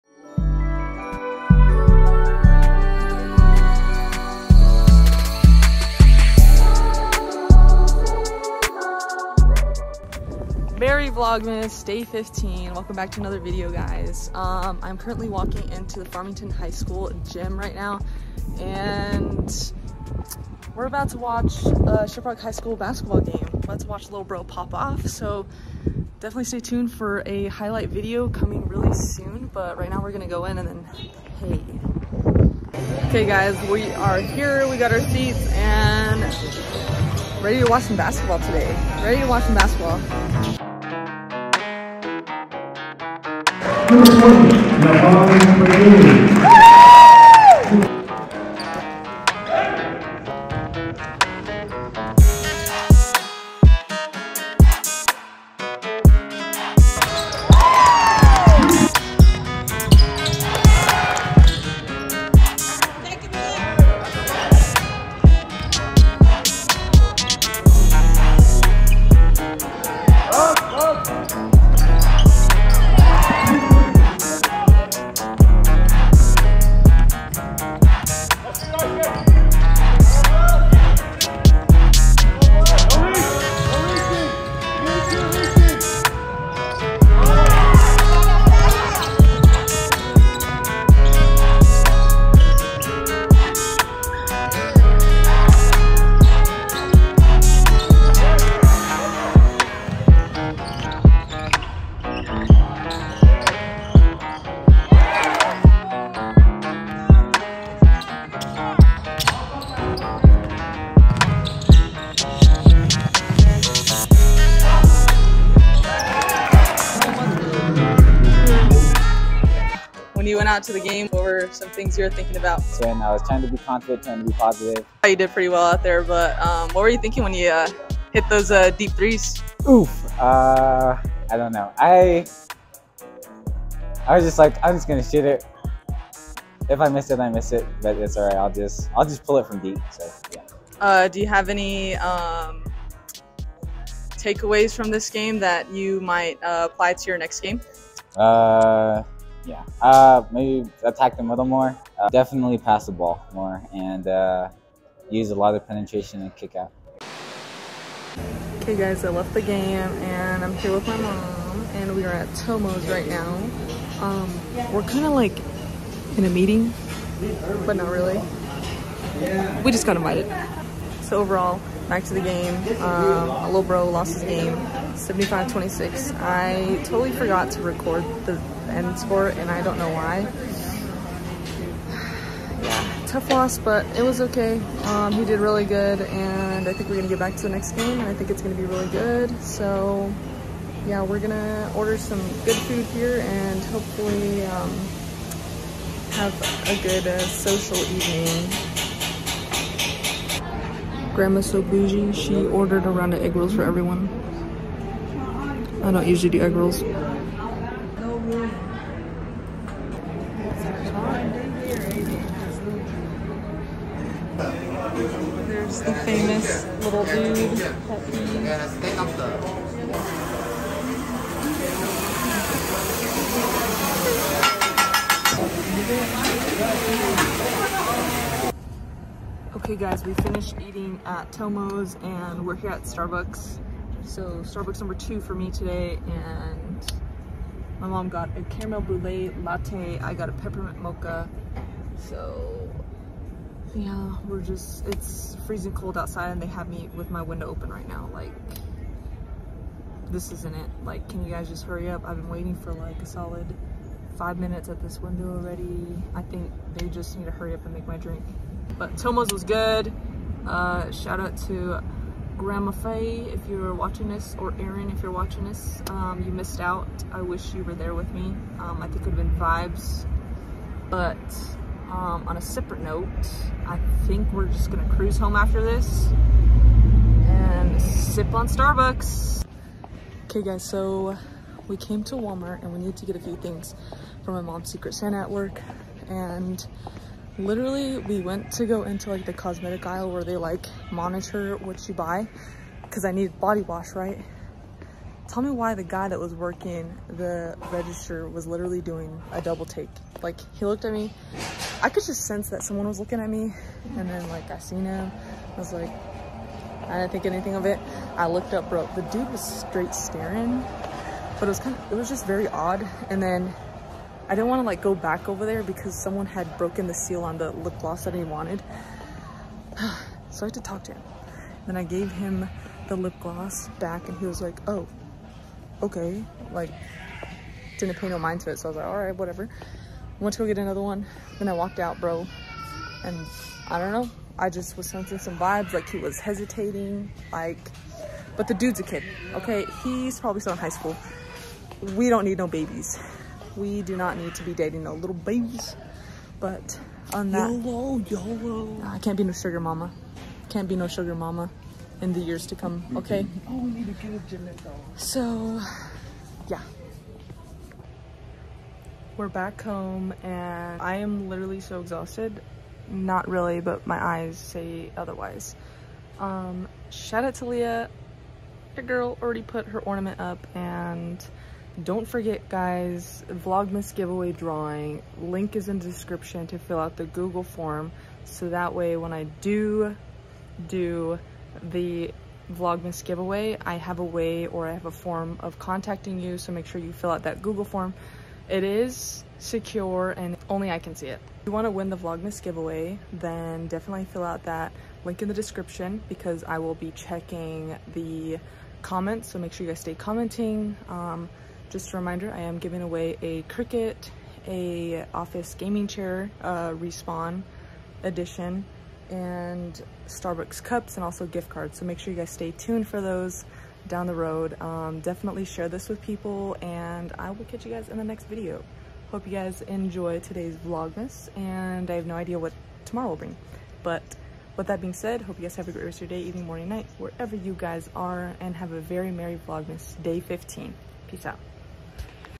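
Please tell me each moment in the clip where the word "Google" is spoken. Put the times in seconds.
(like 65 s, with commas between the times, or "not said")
377 s, 387 s.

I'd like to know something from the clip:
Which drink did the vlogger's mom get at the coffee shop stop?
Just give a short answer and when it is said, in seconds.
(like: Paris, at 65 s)
Caramel brulee latte, at 238 s.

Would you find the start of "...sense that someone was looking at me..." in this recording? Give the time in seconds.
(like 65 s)
302 s.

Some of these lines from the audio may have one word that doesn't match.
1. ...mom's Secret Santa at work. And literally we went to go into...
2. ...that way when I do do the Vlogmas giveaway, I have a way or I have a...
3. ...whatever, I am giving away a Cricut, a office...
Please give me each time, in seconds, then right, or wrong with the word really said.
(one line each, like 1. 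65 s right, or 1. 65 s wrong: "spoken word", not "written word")
1. 284 s right
2. 378 s right
3. 401 s wrong: "reminder", not "whatever".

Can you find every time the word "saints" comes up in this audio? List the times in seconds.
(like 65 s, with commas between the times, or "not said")
not said.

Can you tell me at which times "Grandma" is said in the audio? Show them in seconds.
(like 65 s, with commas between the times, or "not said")
201 s, 262 s.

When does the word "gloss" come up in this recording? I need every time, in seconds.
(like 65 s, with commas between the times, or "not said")
317 s, 323 s.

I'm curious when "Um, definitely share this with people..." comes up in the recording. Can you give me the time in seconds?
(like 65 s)
414 s.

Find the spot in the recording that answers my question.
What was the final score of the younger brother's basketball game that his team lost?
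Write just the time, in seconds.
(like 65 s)
174 s.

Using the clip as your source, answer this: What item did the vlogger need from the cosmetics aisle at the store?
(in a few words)
Body wash.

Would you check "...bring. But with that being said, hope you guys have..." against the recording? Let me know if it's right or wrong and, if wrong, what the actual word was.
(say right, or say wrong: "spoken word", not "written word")
right.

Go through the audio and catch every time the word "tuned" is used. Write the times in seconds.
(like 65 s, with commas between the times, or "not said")
26 s, 412 s.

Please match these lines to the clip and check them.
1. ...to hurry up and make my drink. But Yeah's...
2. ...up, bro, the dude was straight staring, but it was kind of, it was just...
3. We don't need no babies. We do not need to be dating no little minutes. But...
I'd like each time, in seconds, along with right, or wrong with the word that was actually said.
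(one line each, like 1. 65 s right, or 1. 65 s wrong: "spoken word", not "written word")
1. 257 s wrong: "Tomo", not "Yeah"
2. 308 s right
3. 341 s wrong: "babies", not "minutes".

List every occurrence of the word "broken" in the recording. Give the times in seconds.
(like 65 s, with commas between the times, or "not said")
316 s.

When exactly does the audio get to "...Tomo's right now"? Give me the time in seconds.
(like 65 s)
162 s.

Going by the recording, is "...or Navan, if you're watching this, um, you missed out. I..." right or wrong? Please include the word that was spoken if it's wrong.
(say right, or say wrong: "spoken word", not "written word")
wrong: "Erin", not "Navan".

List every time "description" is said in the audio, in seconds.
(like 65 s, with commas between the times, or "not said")
375 s, 395 s.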